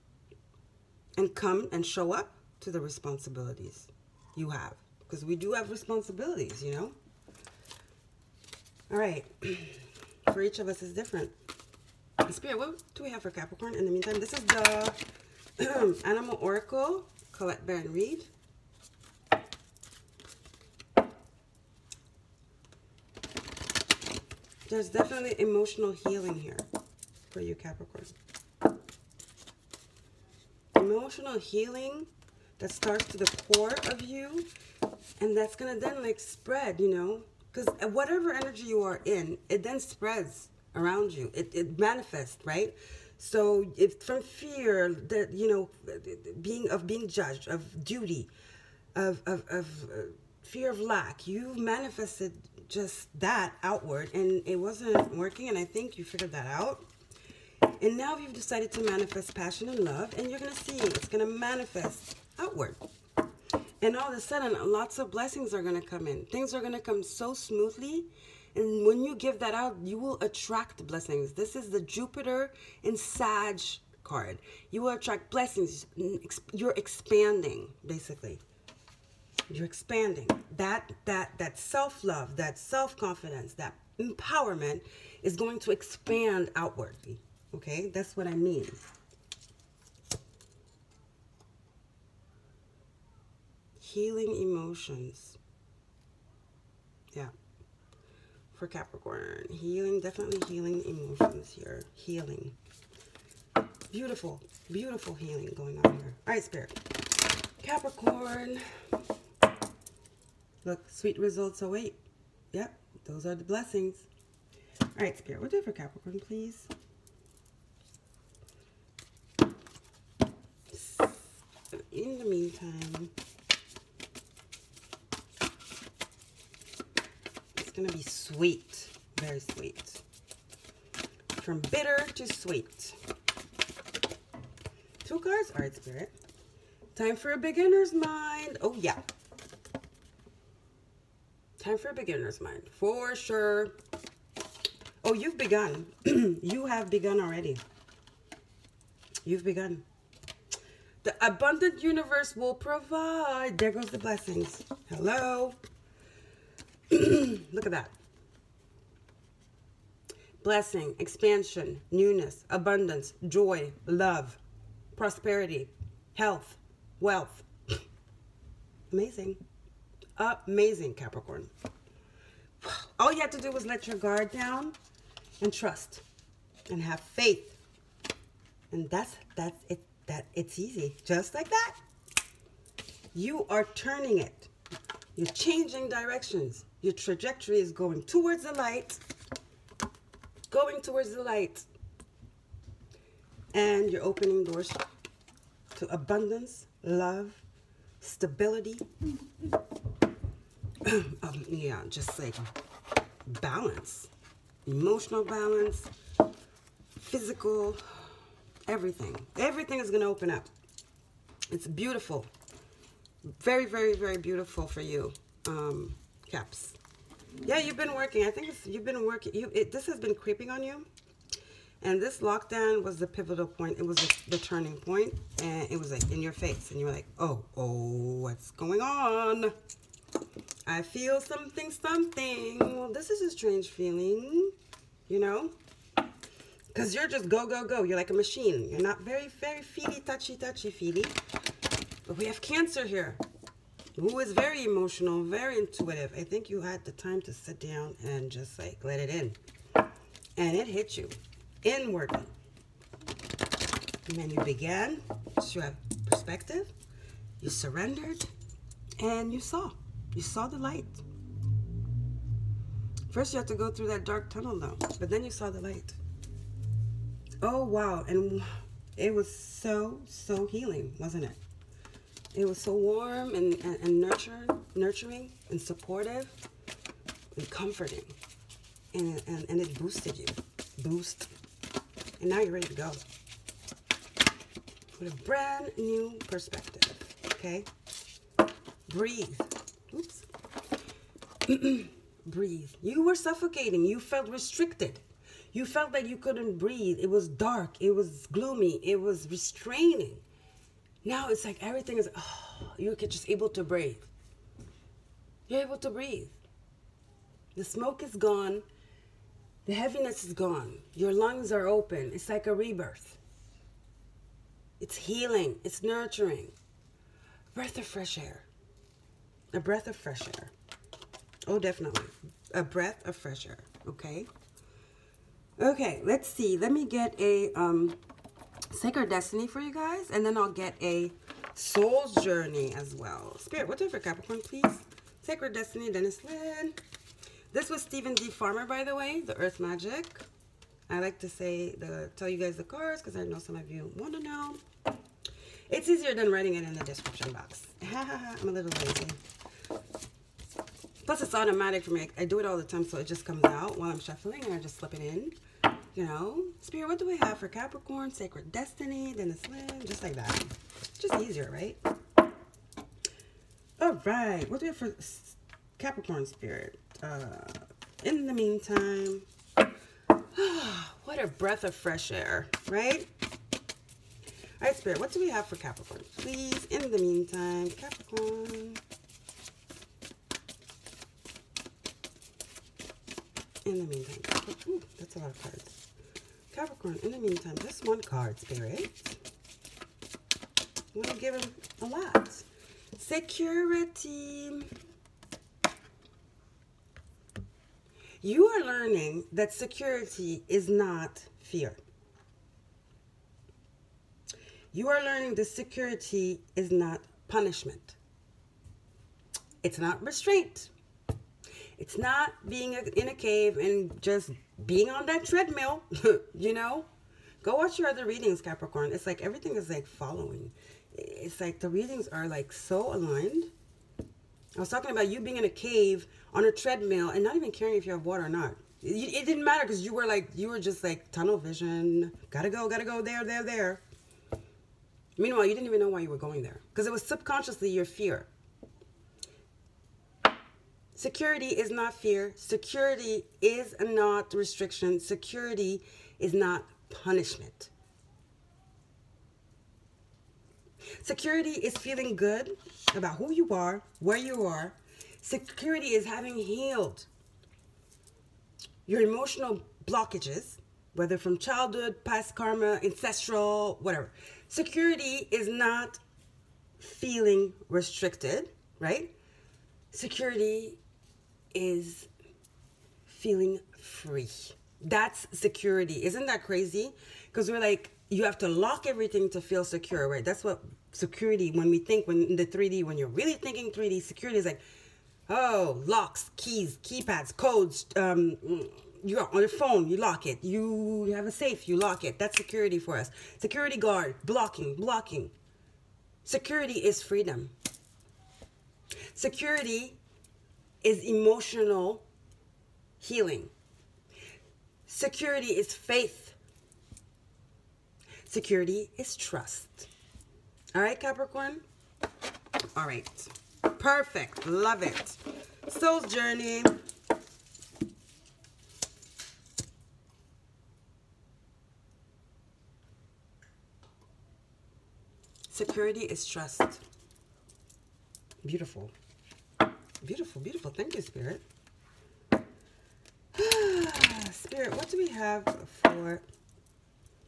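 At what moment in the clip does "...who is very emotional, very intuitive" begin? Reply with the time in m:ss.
4:03.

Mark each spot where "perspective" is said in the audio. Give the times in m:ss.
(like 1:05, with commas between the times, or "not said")
4:16, 4:46.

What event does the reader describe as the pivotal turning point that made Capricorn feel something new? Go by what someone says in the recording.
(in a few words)
lockdown.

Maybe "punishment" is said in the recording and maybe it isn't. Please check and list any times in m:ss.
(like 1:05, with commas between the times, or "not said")
6:47, 7:26.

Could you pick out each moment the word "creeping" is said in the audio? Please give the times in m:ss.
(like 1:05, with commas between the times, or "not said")
3:40.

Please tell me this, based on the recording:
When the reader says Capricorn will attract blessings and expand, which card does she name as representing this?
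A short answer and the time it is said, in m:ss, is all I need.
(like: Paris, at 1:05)
Jupiter and Sag, at 1:11.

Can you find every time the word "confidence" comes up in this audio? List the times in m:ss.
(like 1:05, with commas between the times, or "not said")
1:22.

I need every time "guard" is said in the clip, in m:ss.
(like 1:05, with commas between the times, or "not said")
2:53, 8:13.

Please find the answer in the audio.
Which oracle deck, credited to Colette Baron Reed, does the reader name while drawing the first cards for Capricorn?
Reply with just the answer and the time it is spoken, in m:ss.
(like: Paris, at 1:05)
Animal Oracle, at 0:16.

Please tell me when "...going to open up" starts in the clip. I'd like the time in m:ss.
3:29.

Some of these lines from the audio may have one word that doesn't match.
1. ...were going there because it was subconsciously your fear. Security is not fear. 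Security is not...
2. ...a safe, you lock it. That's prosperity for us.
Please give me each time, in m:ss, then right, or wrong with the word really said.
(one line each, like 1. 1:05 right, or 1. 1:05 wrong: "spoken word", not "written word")
1. 7:16 right
2. 8:11 wrong: "security", not "prosperity".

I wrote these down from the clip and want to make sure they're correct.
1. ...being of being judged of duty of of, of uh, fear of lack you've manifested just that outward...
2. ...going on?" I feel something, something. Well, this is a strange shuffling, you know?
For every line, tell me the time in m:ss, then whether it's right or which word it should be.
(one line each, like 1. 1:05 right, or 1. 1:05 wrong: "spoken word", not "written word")
1. 0:46 right
2. 3:48 wrong: "feeling", not "shuffling".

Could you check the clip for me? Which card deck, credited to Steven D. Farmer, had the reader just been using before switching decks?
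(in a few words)
Earth Magic.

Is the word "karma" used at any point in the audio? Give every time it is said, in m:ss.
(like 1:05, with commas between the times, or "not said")
7:42.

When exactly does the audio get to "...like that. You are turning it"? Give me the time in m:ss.
3:01.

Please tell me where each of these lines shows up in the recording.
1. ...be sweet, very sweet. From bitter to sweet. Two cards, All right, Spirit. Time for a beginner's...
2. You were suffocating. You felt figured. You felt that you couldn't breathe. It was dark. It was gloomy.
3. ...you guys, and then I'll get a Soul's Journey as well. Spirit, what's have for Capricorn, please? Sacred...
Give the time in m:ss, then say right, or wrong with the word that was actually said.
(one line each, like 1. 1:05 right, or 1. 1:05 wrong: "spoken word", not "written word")
1. 2:07 right
2. 4:52 wrong: "restricted", not "figured"
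3. 5:29 right.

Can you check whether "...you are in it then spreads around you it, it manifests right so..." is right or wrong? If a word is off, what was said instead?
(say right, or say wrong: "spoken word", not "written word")
right.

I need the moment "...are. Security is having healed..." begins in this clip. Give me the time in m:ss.
7:34.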